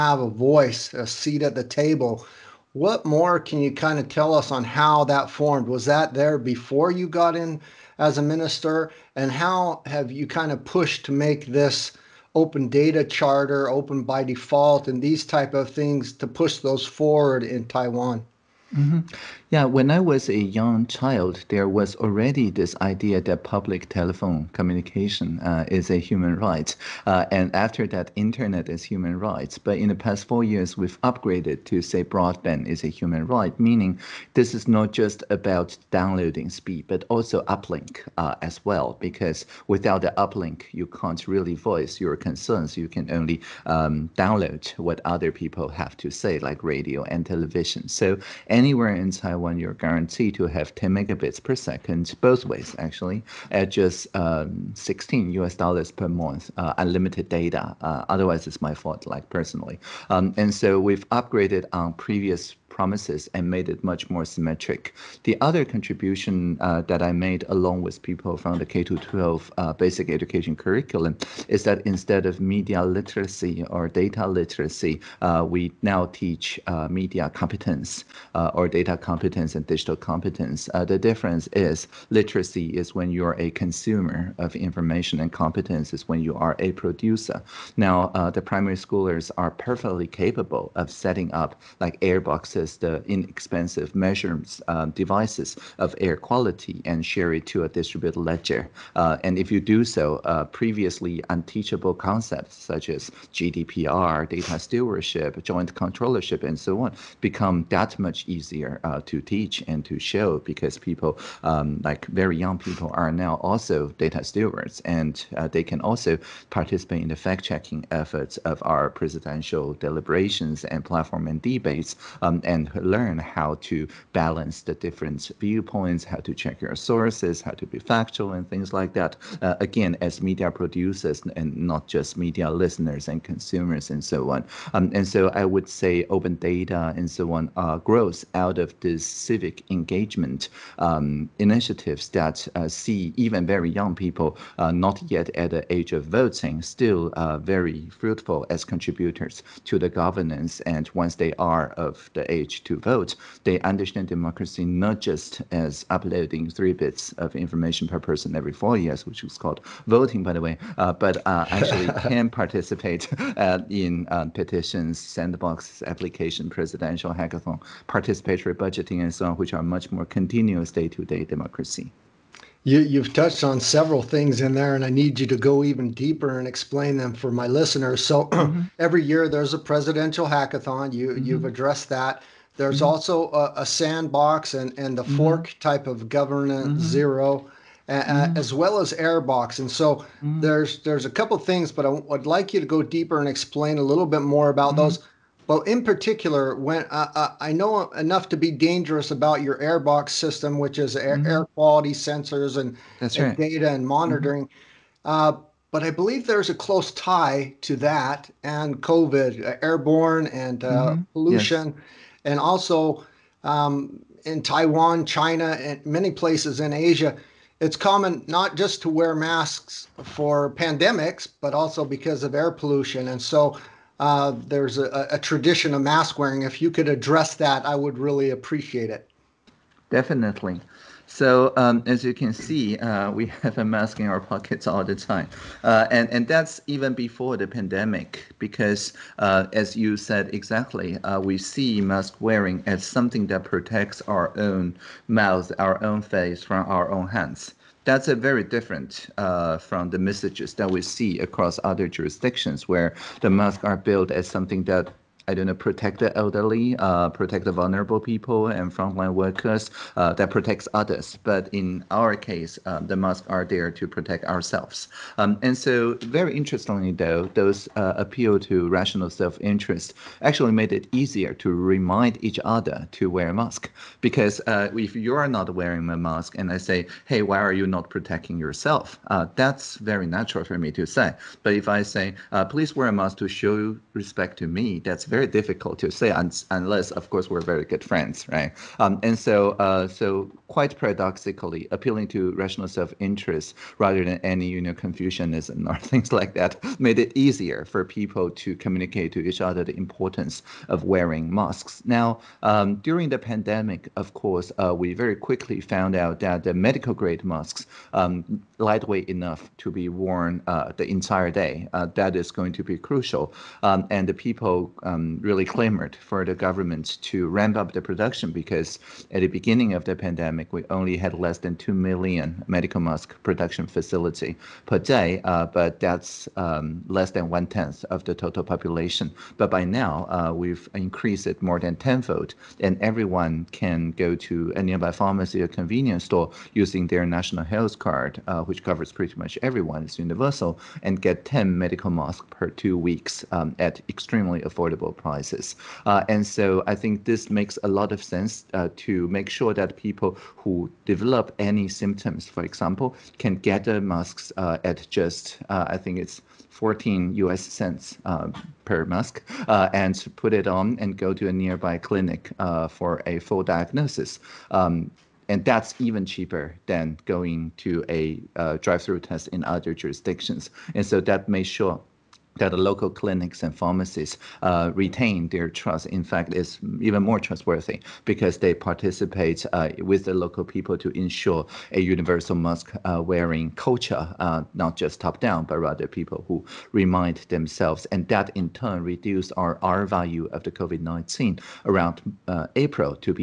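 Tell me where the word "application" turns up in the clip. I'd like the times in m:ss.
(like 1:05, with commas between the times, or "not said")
2:45.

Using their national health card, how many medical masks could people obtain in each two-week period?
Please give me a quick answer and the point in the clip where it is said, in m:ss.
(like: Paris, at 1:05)
10, at 5:41.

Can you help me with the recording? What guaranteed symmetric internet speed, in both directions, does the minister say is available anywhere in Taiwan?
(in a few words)
10 megabits per second.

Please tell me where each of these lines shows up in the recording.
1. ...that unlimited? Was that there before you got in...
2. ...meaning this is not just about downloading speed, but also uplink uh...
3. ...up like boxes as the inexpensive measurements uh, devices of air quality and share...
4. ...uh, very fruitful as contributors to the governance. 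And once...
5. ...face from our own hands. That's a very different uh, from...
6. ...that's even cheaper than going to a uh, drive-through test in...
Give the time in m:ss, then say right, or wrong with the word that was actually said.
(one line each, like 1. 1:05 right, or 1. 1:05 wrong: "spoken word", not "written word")
1. 0:05 wrong: "formed", not "unlimited"
2. 0:33 right
3. 1:31 right
4. 2:27 right
5. 4:06 right
6. 6:05 right.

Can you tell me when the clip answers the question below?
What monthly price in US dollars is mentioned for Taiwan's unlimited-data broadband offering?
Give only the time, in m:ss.
0:54.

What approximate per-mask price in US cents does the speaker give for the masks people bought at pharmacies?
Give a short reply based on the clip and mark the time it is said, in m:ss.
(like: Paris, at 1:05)
14 US cents, at 5:56.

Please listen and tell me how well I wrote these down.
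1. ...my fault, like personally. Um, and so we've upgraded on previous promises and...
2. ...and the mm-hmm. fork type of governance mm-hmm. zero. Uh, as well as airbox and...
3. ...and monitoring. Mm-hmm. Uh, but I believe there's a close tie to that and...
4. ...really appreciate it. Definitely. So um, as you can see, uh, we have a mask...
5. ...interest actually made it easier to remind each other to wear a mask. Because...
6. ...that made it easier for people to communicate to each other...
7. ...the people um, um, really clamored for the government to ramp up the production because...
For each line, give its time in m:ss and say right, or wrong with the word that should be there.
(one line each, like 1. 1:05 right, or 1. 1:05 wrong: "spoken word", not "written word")
1. 0:58 right
2. 3:04 right
3. 3:23 right
4. 3:47 right
5. 4:29 right
6. 4:56 right
7. 5:14 right.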